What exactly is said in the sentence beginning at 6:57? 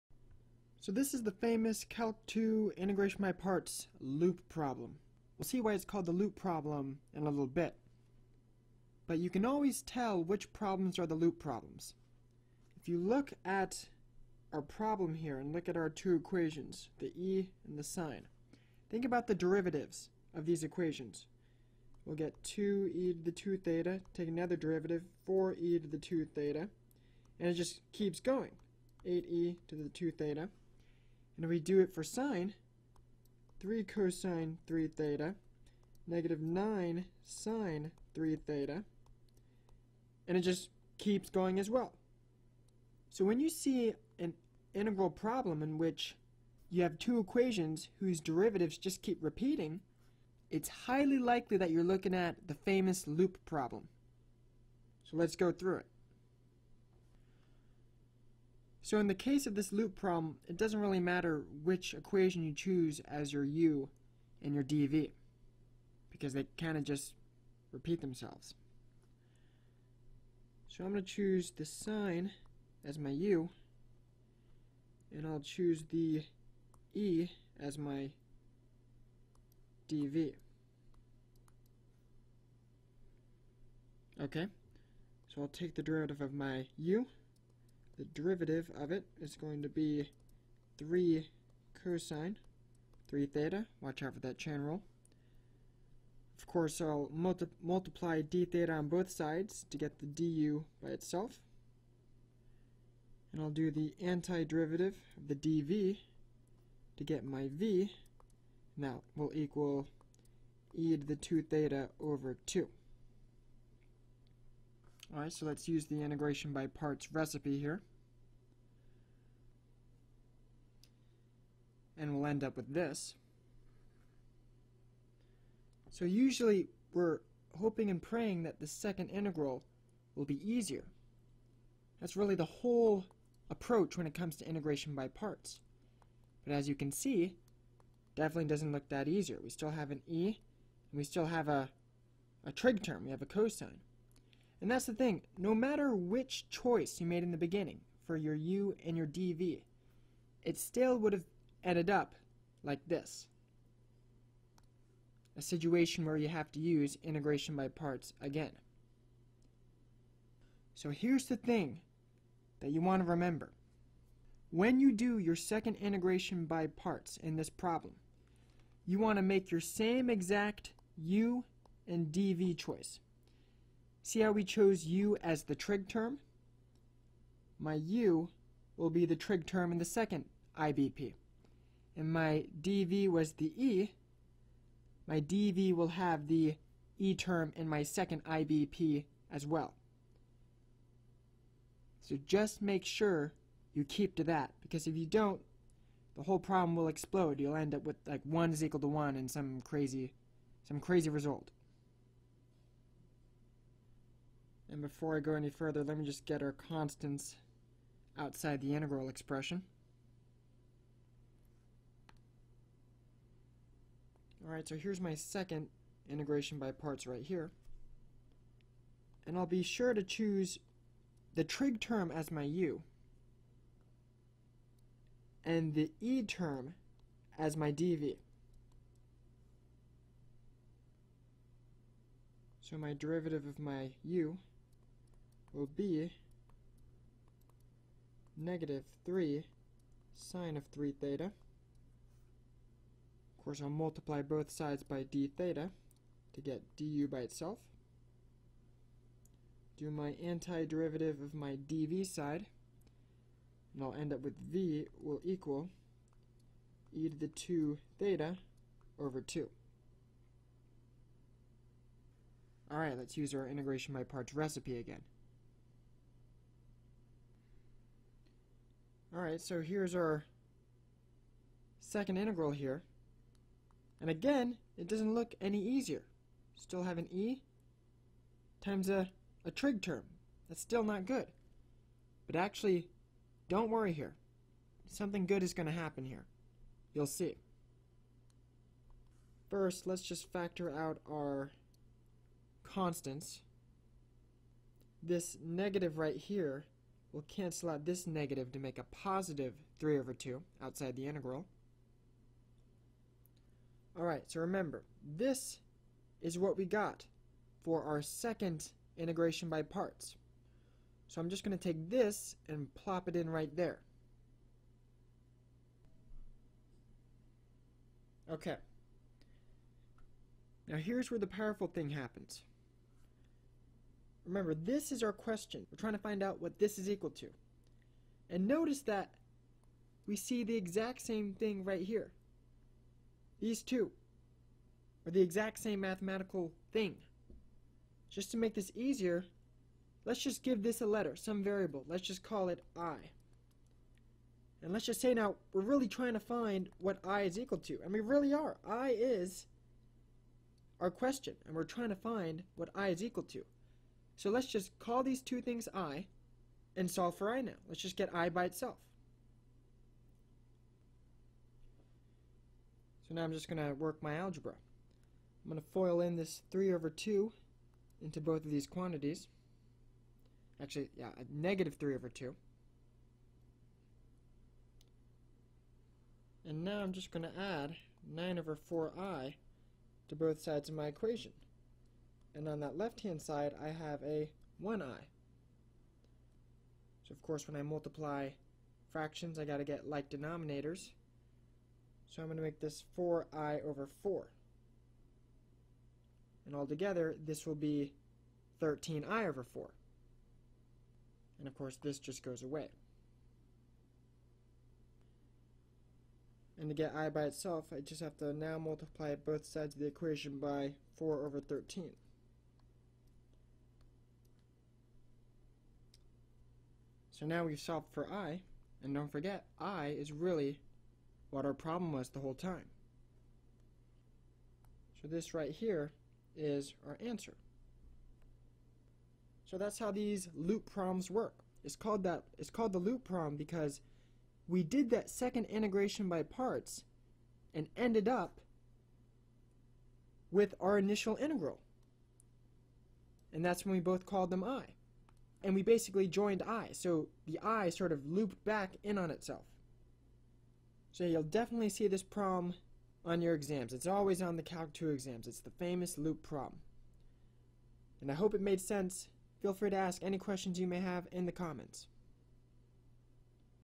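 So now we've solved for i, and don't forget, i is really what our problem was the whole time.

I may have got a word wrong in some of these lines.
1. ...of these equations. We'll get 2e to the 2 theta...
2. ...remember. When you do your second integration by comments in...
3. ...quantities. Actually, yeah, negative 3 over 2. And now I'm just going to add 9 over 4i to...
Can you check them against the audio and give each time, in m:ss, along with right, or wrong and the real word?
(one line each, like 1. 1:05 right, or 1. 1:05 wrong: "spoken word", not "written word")
1. 0:20 right
2. 2:43 wrong: "parts", not "comments"
3. 6:08 right.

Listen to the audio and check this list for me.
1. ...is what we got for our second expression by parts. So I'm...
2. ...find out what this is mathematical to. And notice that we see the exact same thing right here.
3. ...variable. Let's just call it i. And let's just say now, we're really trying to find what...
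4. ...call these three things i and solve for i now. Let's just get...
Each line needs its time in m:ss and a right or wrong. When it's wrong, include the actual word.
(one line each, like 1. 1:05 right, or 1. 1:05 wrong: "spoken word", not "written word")
1. 5:06 wrong: "integration", not "expression"
2. 5:25 wrong: "equal", not "mathematical"
3. 5:41 right
4. 5:54 wrong: "two", not "three".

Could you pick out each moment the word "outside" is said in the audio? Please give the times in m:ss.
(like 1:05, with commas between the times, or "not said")
3:28, 5:00.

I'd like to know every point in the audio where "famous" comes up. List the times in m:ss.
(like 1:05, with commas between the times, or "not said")
0:01, 0:52, 7:35.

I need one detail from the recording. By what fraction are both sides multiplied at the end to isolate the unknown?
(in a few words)
4/13.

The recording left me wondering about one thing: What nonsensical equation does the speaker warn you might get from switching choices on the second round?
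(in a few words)
1 is equal to 1.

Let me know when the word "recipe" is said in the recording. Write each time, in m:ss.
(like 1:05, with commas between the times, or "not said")
1:57, 4:24.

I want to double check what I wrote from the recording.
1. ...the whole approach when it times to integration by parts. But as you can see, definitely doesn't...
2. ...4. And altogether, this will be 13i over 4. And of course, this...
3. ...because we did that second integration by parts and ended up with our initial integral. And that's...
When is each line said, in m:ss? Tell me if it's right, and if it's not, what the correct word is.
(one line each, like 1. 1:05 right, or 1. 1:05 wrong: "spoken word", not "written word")
1. 2:12 wrong: "comes", not "times"
2. 6:34 right
3. 7:13 right.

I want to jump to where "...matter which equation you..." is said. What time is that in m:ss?
1:00.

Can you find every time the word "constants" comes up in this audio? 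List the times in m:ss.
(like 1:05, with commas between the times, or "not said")
3:26, 4:52.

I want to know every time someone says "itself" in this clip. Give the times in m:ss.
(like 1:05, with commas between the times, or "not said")
1:40, 4:07, 5:58, 6:47, 7:29.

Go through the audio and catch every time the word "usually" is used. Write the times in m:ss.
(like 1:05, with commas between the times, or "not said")
2:06.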